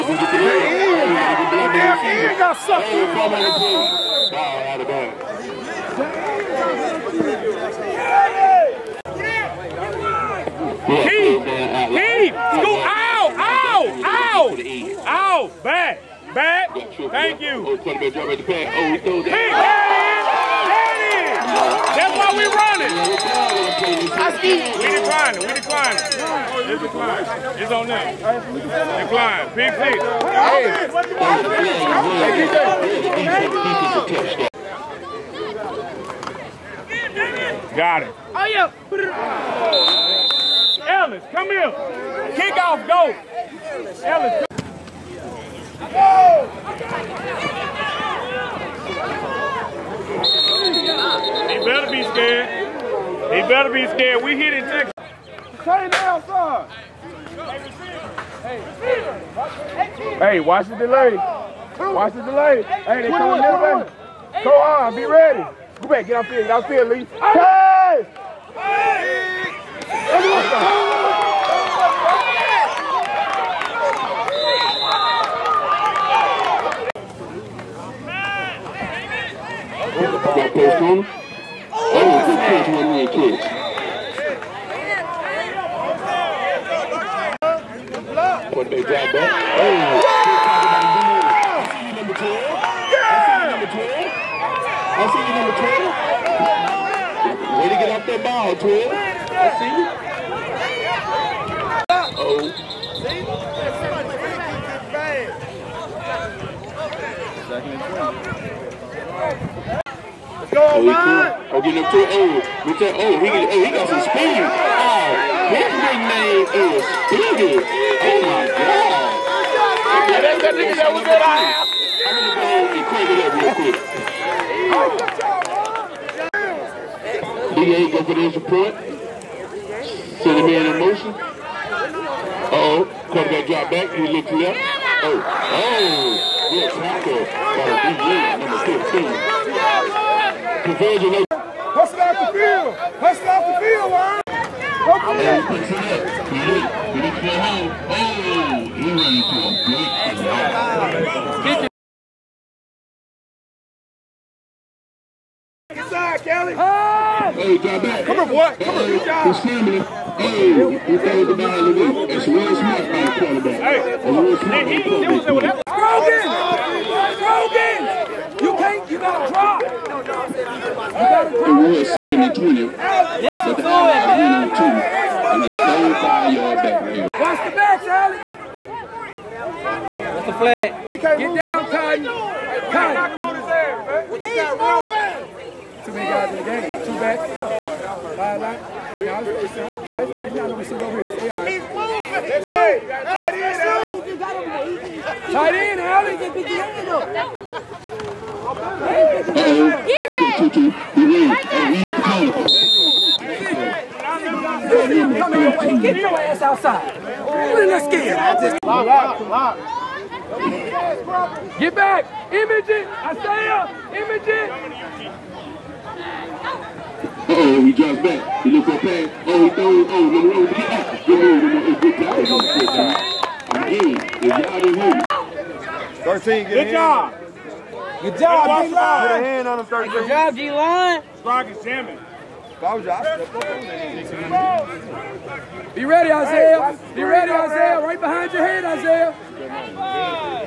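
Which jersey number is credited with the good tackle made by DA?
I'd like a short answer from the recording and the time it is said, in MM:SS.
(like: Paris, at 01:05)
15, at 02:18.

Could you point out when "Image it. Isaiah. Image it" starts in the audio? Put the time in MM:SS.
03:32.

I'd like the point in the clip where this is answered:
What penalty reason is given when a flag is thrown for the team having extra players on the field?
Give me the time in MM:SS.
03:05.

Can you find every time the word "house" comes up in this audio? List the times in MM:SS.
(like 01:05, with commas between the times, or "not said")
02:01.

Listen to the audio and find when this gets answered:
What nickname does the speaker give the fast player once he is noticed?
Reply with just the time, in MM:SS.
01:57.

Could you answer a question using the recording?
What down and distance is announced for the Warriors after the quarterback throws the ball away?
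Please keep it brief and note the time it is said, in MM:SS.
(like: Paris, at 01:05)
second and 20, at 02:51.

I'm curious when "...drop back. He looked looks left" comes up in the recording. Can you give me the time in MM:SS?
02:13.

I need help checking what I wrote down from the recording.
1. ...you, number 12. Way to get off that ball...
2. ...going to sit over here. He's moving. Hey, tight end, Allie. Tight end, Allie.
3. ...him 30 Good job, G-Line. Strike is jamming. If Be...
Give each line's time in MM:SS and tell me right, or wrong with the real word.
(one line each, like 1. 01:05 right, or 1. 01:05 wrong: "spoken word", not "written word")
1. 01:35 right
2. 03:10 right
3. 03:49 right.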